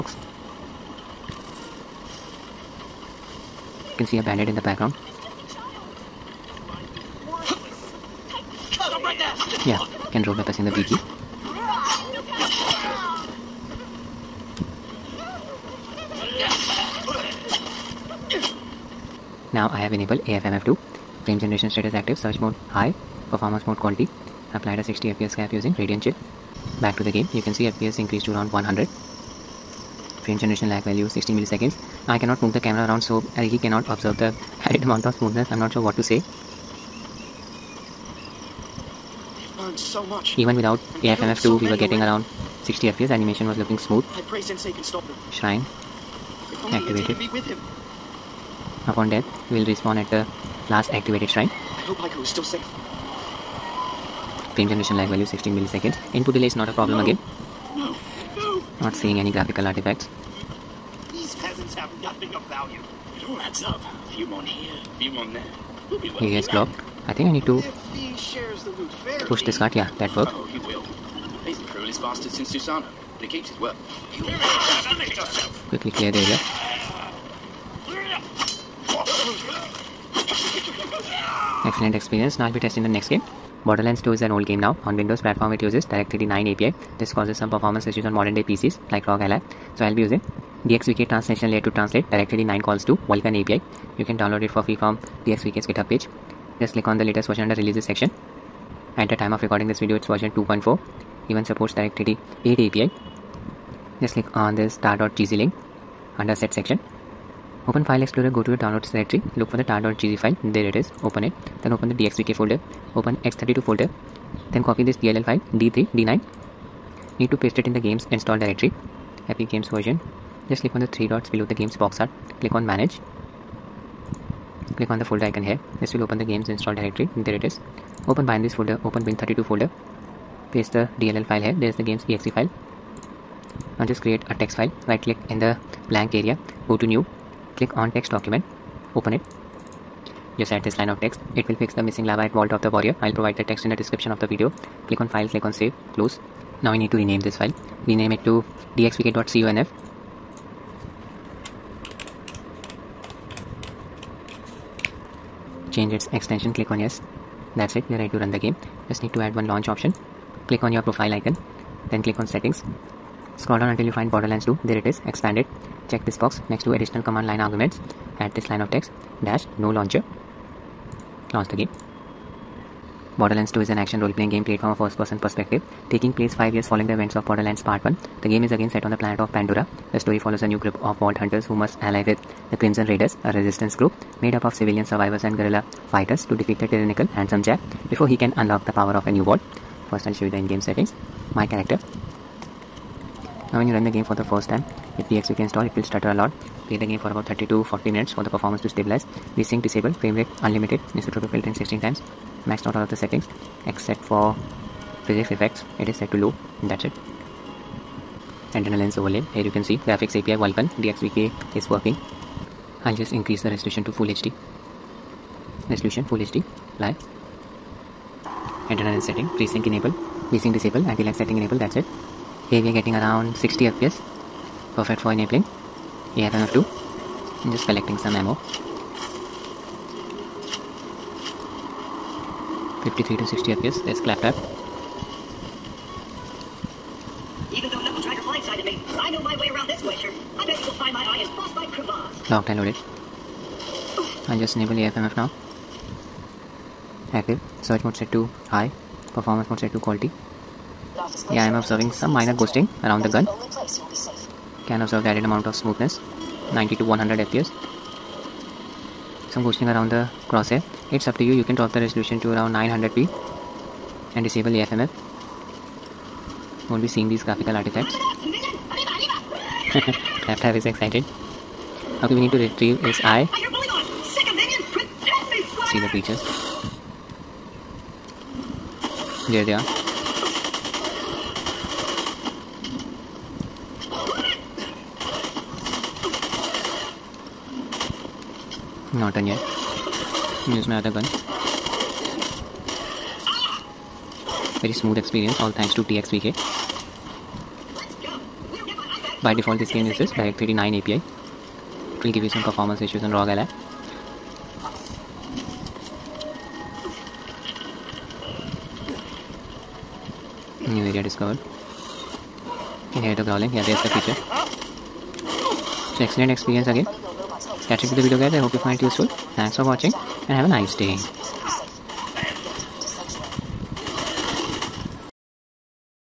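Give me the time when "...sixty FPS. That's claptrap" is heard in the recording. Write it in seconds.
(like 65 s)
233 s.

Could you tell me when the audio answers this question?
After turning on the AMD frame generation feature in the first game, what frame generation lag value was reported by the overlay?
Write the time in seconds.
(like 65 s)
30 s.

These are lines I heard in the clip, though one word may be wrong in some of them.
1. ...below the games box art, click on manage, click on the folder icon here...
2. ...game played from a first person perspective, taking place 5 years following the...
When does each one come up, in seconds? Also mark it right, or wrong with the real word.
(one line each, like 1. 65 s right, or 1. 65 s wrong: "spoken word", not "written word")
1. 121 s right
2. 174 s right.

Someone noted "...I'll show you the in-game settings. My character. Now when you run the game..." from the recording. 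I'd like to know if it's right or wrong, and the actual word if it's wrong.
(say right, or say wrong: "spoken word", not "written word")
right.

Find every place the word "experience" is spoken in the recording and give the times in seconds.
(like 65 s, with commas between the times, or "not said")
81 s, 316 s.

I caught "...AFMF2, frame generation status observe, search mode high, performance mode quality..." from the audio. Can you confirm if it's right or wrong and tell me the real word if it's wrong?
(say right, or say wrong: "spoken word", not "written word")
wrong: "active", not "observe".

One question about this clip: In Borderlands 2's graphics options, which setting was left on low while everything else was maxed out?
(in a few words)
Physics effects.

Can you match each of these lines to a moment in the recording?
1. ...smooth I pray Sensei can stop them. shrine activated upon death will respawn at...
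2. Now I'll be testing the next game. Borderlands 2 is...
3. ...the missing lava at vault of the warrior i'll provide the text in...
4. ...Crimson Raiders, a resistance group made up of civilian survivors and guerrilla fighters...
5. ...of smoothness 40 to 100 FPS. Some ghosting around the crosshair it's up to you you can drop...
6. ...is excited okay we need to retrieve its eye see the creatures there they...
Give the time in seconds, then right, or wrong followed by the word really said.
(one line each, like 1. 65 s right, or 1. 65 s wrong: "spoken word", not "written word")
1. 43 s right
2. 82 s right
3. 141 s right
4. 182 s right
5. 255 s wrong: "90", not "40"
6. 270 s right.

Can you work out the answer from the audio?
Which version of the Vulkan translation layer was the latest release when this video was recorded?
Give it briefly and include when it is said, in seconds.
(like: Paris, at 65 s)
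2.4, at 100 s.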